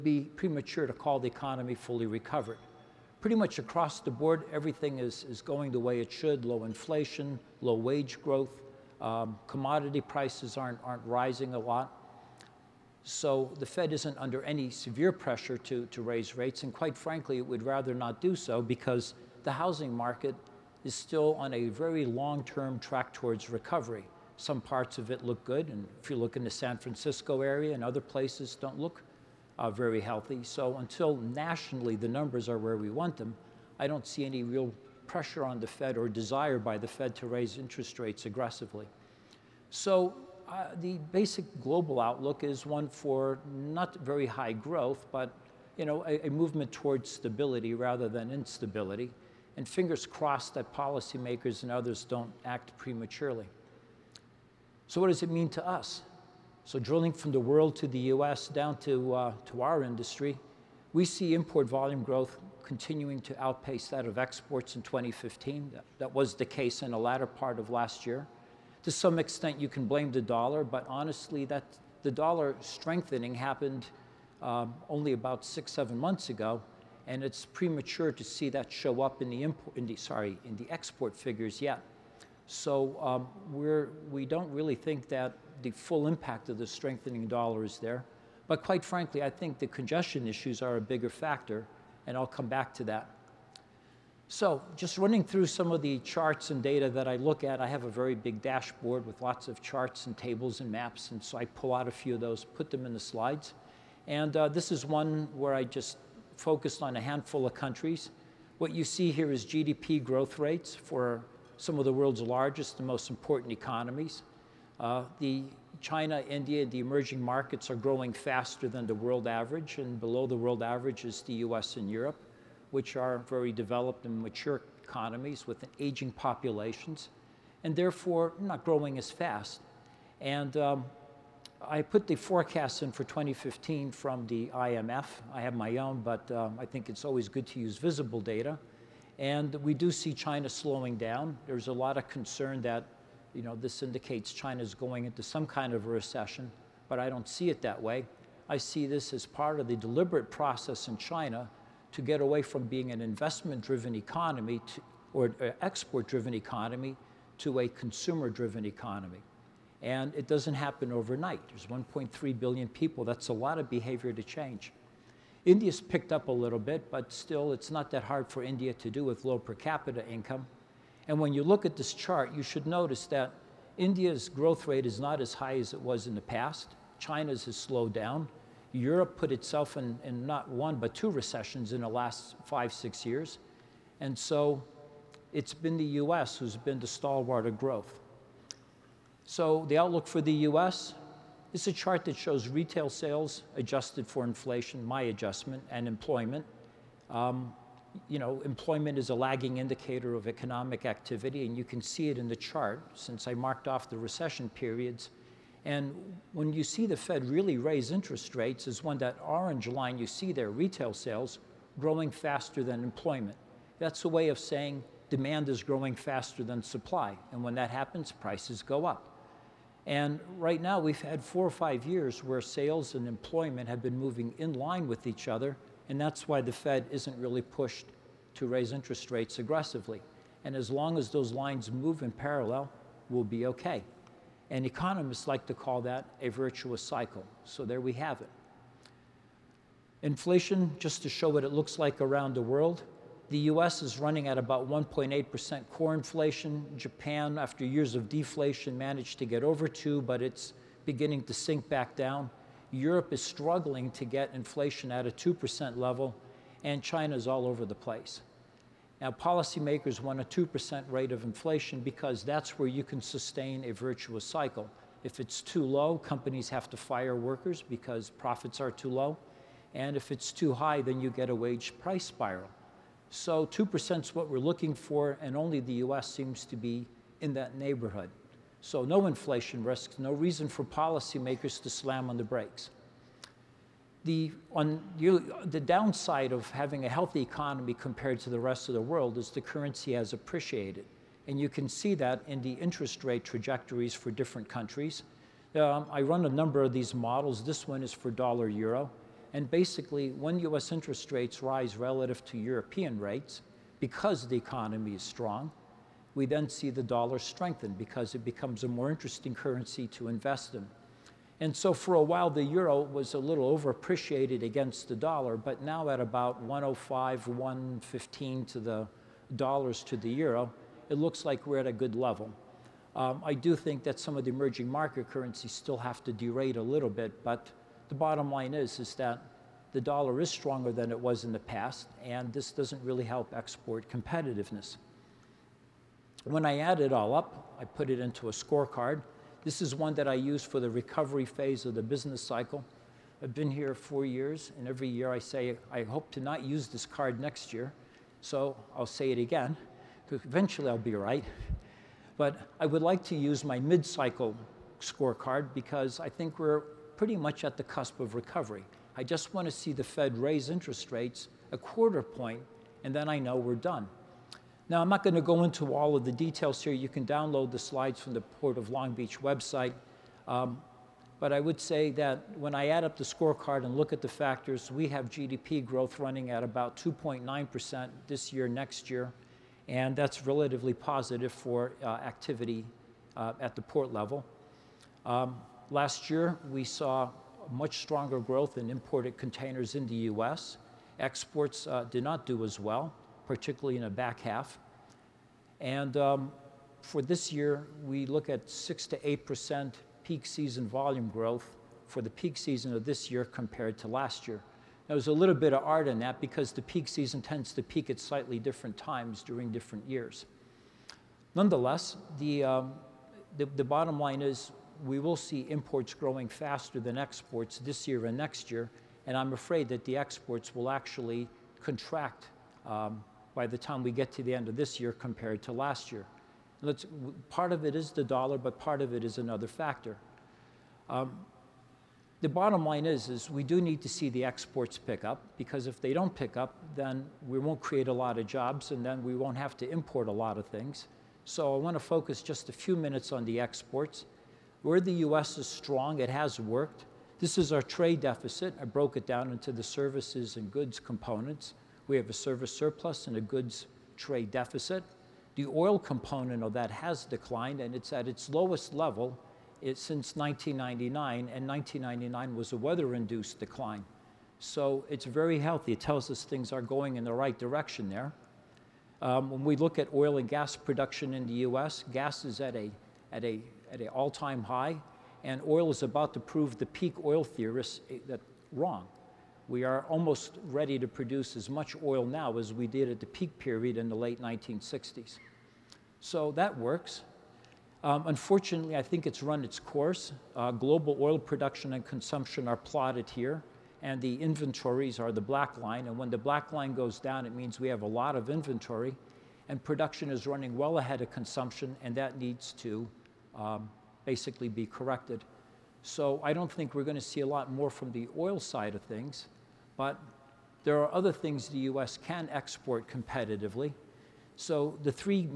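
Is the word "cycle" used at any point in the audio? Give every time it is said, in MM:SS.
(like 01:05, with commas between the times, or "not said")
03:56, 04:24, 05:42, 05:53.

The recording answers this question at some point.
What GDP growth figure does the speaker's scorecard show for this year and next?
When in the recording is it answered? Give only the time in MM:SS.
06:16.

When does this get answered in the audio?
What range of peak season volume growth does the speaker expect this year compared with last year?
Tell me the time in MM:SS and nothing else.
06:38.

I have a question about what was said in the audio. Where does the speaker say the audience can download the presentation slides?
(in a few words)
Port of Long Beach website.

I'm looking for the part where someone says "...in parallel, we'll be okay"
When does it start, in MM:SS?
03:52.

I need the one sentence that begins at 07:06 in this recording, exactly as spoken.
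Let's, part of it is the dollar, but part of it is another factor.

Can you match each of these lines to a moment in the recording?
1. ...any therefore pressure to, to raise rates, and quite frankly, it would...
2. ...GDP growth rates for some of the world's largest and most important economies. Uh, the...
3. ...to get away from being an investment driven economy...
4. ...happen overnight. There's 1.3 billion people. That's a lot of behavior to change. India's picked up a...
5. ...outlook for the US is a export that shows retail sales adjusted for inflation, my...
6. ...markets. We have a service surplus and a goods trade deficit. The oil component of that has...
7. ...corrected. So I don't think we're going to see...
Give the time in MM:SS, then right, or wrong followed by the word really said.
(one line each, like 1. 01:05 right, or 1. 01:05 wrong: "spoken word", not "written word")
1. 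00:14 wrong: "severe", not "therefore"
2. 01:49 right
3. 02:31 right
4. 02:40 right
5. 03:09 wrong: "chart", not "export"
6. 07:30 wrong: "components", not "markets"
7. 08:24 right.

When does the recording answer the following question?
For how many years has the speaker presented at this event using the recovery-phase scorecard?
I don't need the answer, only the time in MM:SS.
05:43.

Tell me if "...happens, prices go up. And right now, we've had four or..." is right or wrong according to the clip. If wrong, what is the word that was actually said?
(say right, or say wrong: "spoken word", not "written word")
right.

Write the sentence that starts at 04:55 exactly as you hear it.
Um, I run a number of these models.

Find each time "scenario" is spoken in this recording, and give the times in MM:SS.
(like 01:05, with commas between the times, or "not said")
not said.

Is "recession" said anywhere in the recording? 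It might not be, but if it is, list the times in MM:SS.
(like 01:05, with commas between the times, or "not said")
02:25, 03:01, 03:23.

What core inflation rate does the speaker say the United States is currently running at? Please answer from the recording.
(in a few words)
1.8%.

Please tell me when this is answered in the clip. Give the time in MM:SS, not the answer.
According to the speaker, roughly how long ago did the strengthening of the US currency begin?
01:15.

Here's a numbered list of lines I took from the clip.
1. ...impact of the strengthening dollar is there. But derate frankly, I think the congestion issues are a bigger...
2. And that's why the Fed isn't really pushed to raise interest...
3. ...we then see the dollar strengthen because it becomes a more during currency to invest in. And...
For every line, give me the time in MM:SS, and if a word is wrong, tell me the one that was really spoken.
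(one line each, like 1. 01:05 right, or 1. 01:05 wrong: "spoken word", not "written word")
1. 01:26 wrong: "quite", not "derate"
2. 03:45 right
3. 05:06 wrong: "interesting", not "during".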